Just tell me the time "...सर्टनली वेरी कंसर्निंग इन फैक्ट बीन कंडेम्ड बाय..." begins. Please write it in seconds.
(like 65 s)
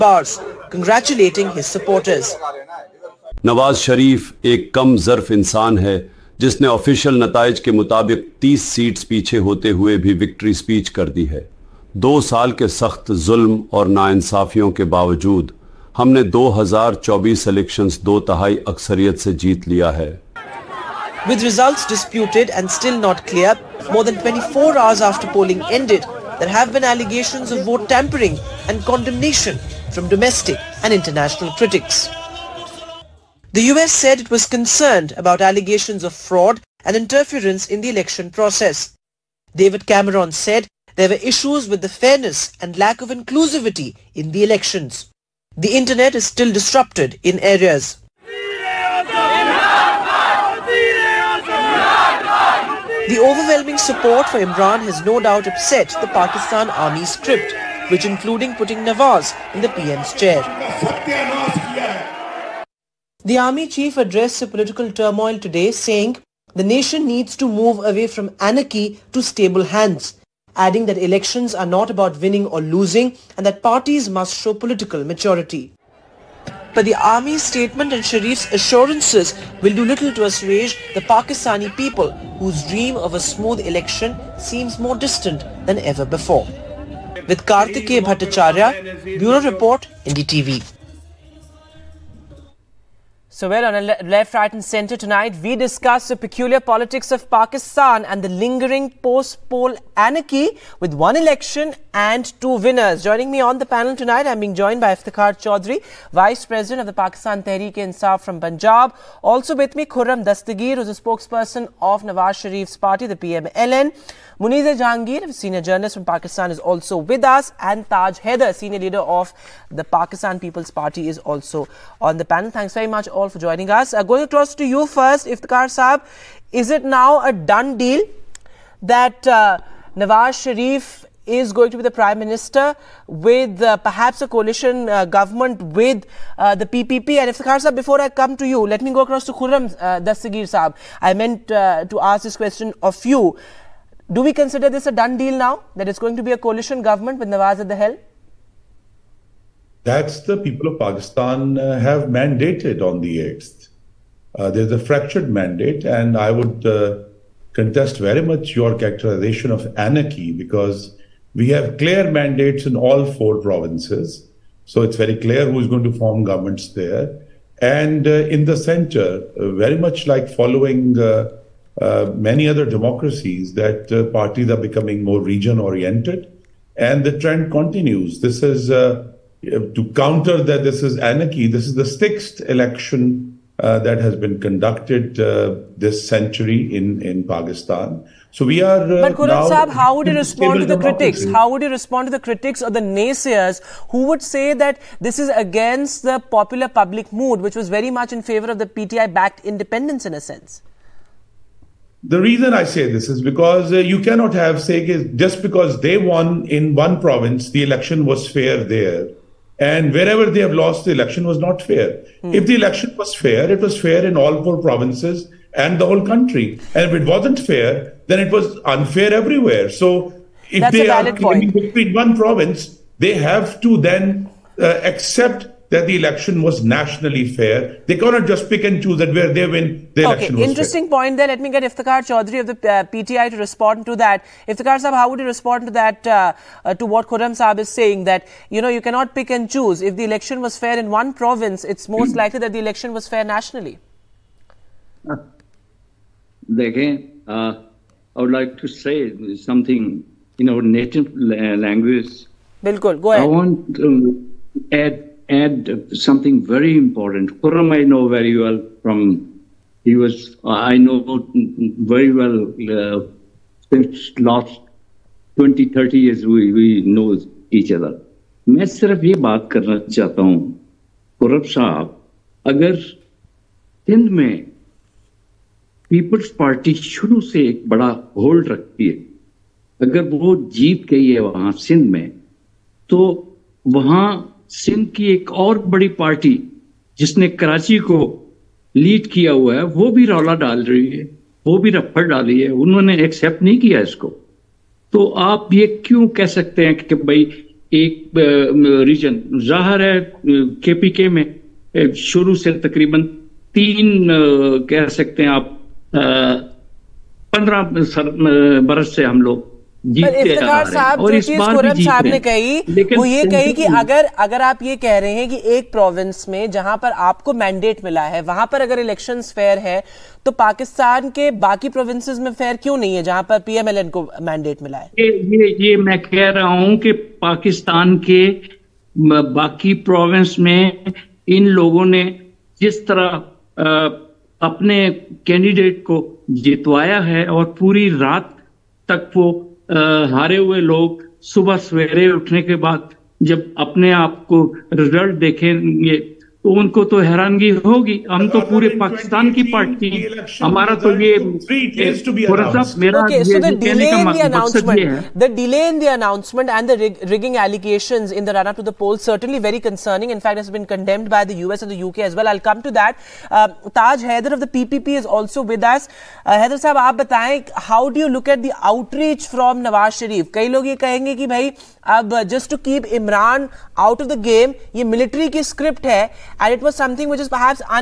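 359 s.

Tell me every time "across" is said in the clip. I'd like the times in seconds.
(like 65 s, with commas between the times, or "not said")
124 s, 138 s.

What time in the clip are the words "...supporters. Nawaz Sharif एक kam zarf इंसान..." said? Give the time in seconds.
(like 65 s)
1 s.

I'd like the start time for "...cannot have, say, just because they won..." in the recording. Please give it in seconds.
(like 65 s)
203 s.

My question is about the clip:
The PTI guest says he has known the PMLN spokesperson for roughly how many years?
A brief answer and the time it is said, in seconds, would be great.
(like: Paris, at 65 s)
20-30 years, at 265 s.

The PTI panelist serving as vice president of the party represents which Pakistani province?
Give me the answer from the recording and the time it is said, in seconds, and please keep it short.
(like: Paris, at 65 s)
Punjab, at 108 s.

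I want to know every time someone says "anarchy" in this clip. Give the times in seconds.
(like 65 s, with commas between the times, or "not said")
68 s, 99 s, 159 s, 180 s.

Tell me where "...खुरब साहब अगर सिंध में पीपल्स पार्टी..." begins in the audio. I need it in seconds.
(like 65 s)
271 s.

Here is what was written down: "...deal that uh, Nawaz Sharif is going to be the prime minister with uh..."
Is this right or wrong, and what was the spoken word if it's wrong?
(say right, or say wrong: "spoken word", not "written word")
right.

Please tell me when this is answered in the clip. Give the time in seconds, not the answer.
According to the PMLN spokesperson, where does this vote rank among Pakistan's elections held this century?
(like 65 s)
181 s.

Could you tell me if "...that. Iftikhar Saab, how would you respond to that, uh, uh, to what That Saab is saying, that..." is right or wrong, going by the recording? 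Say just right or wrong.
wrong.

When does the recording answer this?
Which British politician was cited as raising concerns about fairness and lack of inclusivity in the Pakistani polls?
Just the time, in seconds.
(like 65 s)
39 s.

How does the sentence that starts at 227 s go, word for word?
They cannot just pick and choose that where they win, the okay, election was interesting fair.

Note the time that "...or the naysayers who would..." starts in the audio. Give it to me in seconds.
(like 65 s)
192 s.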